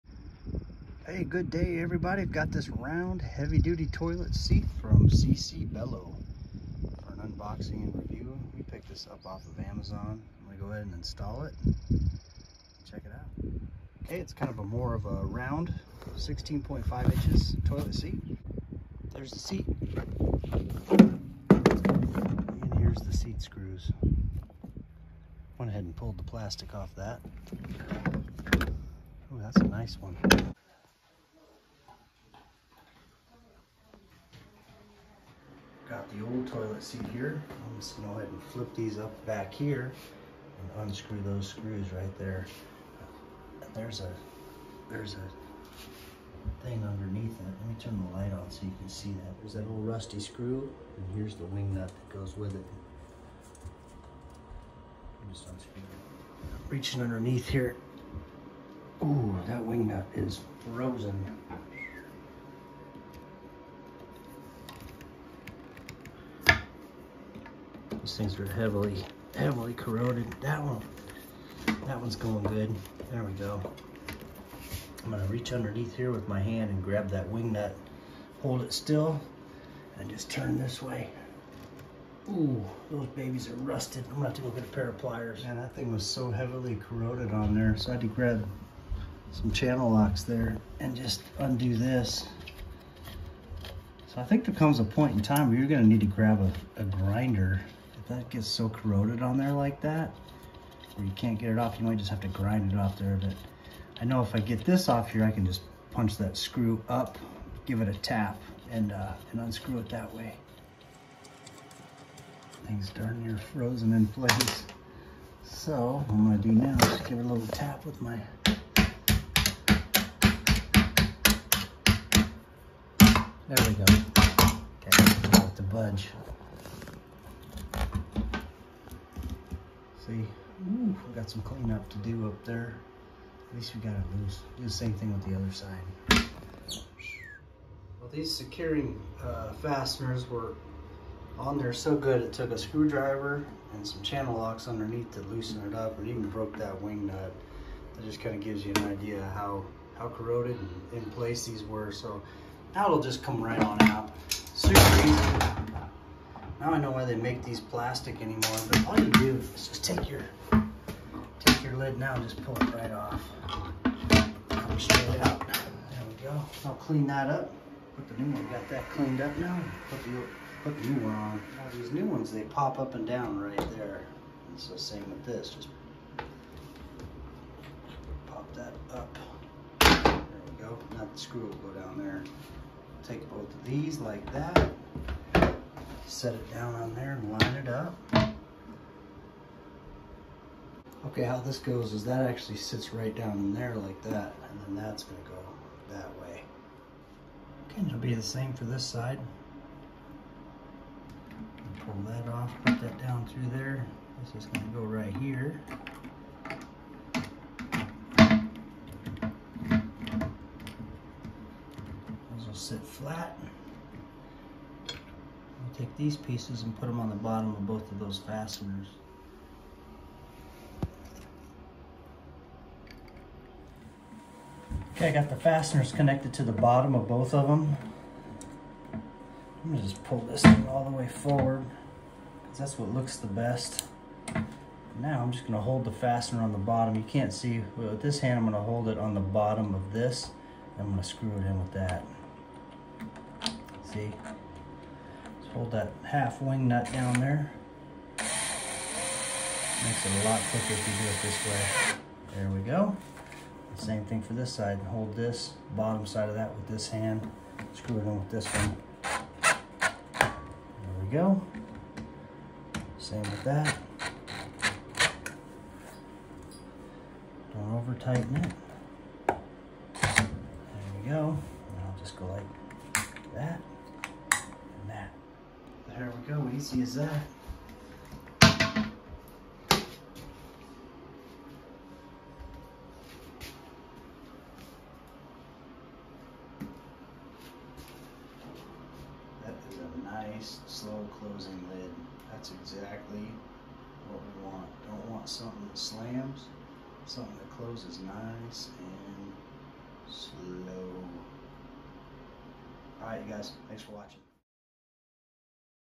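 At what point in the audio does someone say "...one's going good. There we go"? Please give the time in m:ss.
1:12.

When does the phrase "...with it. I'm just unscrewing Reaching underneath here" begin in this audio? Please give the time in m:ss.
0:52.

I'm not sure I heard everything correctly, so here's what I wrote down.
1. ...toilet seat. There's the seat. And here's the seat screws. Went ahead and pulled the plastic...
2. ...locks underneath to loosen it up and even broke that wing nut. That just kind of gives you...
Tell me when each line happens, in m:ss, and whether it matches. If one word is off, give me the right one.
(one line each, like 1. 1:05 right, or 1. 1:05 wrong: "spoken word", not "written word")
1. 0:17 right
2. 2:24 right.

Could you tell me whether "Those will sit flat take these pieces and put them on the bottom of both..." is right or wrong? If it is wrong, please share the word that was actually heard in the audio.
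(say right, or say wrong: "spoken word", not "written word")
right.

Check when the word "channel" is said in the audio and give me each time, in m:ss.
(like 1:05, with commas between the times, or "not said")
1:29, 2:24.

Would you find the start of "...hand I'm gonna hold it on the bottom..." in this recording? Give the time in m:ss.
3:58.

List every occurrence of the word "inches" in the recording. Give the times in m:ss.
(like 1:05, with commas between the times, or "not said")
0:17.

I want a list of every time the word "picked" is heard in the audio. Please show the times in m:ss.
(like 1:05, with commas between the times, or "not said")
0:08.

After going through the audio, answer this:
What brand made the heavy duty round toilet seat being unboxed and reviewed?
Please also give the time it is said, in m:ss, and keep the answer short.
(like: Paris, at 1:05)
CC Bello, at 0:05.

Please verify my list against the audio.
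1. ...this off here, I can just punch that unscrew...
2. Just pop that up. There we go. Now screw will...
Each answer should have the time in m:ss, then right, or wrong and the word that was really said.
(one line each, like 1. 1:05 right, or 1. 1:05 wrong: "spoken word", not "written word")
1. 1:44 wrong: "screw", not "unscrew"
2. 2:55 right.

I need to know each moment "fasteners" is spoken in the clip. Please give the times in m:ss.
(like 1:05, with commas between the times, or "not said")
2:19, 3:38, 3:45, 3:55.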